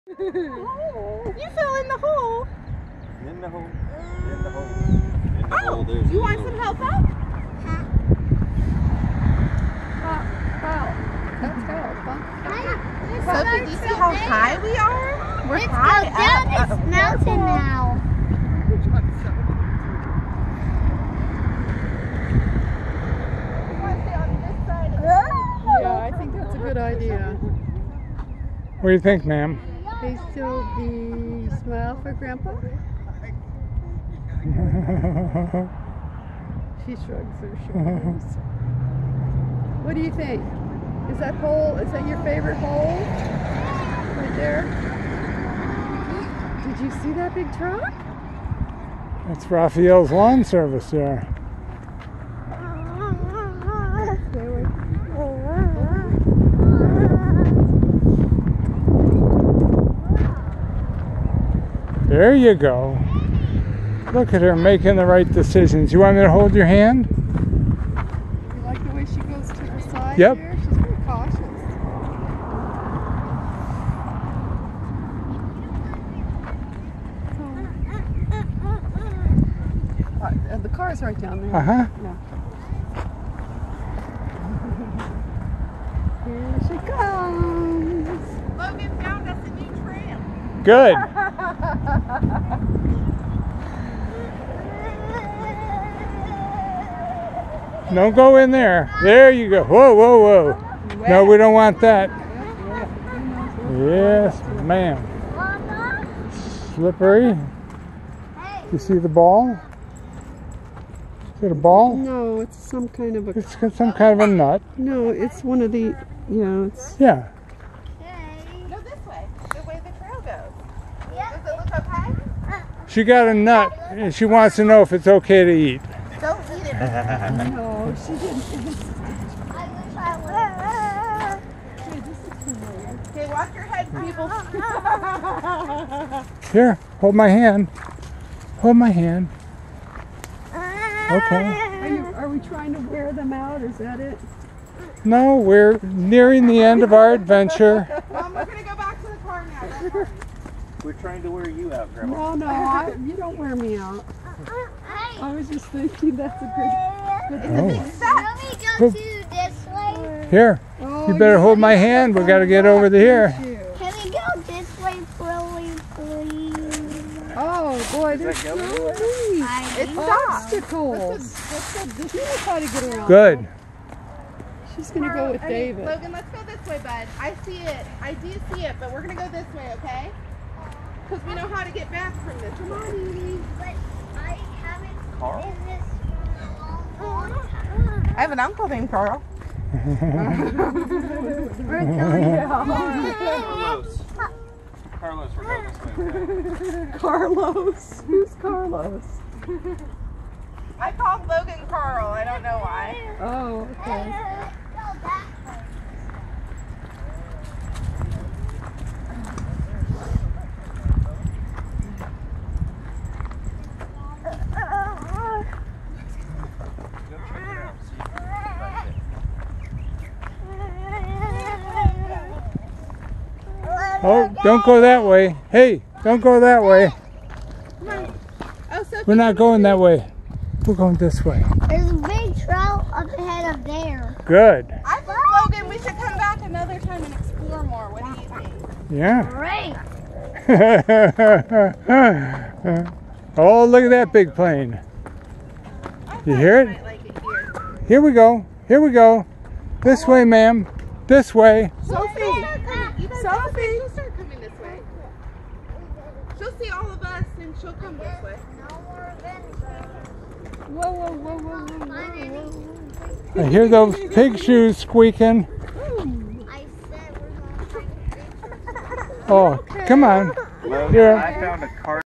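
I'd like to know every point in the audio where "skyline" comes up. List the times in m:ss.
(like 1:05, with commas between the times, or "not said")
not said.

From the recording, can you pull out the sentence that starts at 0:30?
they still be smile for grandpa?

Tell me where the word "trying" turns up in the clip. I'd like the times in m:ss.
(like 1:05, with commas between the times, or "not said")
2:22, 2:30.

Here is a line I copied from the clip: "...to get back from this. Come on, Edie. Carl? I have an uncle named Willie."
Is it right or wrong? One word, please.
wrong.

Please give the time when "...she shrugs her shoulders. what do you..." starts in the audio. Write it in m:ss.
0:36.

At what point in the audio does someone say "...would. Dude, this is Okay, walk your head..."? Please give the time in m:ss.
2:11.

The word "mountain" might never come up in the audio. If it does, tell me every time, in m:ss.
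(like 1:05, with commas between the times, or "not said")
0:16.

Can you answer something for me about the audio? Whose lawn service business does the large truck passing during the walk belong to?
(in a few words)
Raphael.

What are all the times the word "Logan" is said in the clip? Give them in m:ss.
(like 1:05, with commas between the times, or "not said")
1:28, 2:55, 3:21, 3:55.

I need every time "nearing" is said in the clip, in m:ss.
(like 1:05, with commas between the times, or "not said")
2:25.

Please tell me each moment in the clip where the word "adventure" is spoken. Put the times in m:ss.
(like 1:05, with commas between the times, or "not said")
2:27.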